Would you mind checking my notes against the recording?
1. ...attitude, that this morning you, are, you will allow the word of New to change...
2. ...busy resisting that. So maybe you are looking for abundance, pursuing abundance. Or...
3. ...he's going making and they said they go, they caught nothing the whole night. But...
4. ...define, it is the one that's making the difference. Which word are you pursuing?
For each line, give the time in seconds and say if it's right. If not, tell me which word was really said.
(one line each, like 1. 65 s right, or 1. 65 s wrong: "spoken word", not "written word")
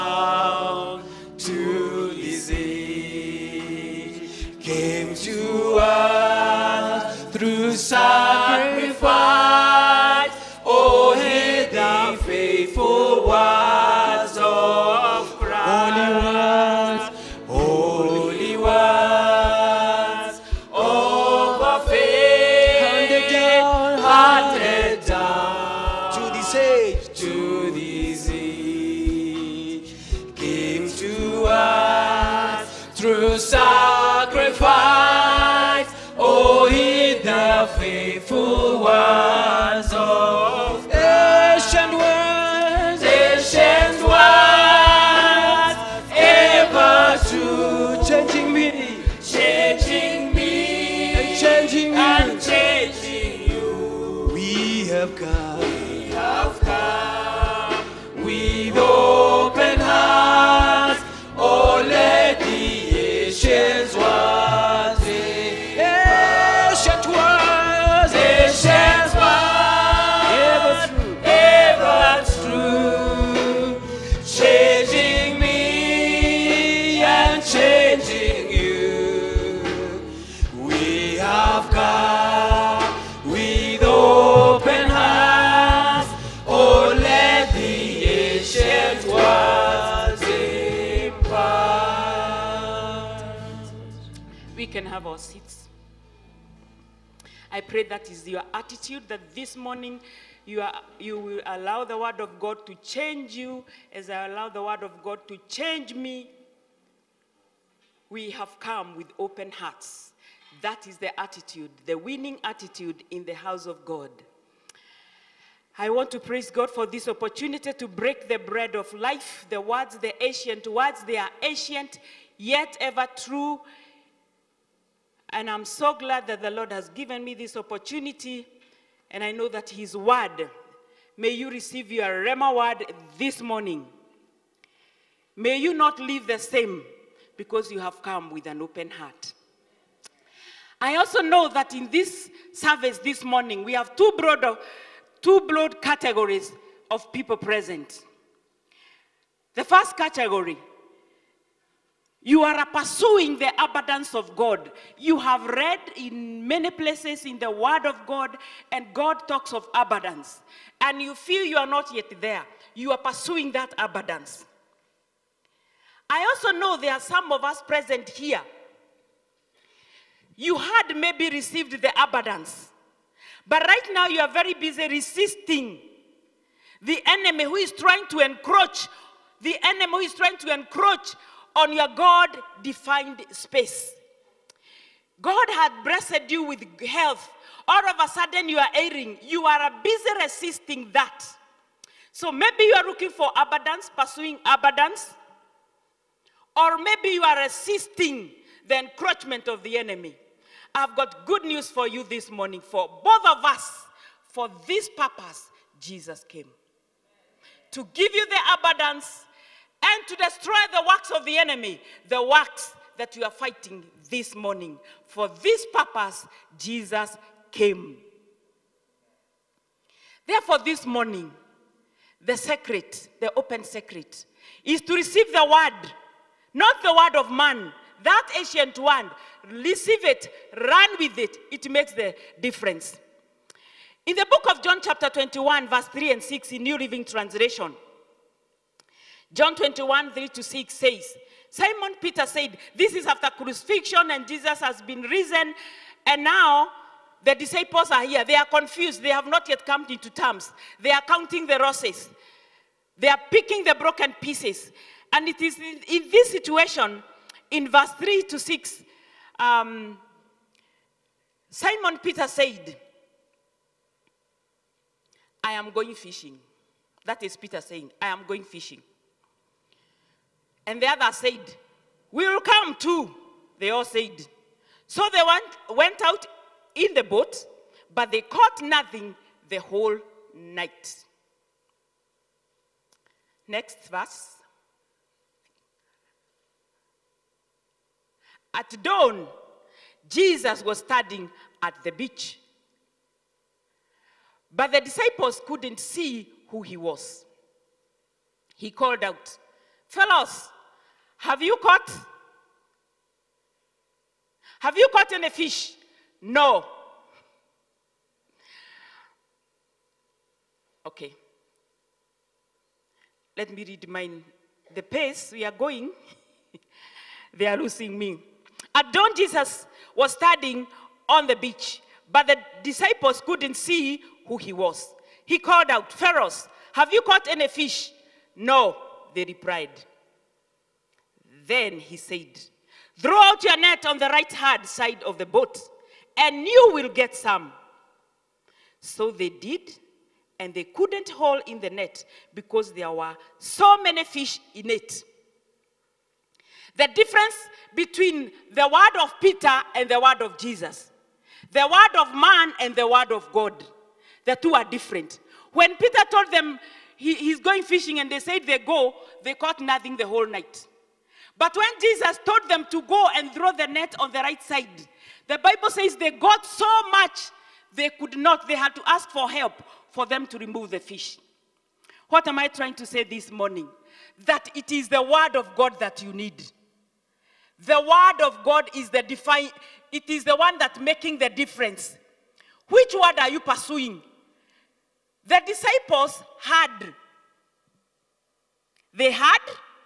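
1. 98 s wrong: "God", not "New"
2. 189 s right
3. 357 s wrong: "fishing", not "making"
4. 379 s right.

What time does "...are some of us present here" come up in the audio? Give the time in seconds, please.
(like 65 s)
166 s.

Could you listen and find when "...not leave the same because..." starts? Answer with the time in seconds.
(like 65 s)
135 s.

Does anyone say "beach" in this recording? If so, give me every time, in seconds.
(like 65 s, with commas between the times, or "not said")
291 s, 321 s.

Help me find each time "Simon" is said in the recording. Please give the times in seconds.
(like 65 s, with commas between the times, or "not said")
241 s, 261 s.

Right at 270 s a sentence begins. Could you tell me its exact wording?
And the other said, We will come too, they all said.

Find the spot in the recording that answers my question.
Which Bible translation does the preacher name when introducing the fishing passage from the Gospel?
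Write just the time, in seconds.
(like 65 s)
236 s.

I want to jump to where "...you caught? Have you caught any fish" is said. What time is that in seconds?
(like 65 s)
301 s.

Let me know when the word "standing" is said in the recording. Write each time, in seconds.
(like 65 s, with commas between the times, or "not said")
290 s, 320 s.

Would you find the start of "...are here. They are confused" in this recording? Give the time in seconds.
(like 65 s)
247 s.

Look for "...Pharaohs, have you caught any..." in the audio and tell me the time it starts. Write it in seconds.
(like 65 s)
325 s.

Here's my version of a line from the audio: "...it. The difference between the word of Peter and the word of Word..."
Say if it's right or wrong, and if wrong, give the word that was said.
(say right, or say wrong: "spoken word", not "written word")
wrong: "Jesus", not "Word".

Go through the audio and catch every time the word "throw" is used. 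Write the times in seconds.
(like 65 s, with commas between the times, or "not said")
332 s, 363 s.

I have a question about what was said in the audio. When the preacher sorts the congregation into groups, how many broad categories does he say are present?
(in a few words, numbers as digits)
2.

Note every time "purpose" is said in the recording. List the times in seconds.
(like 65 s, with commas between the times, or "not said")
204 s, 215 s.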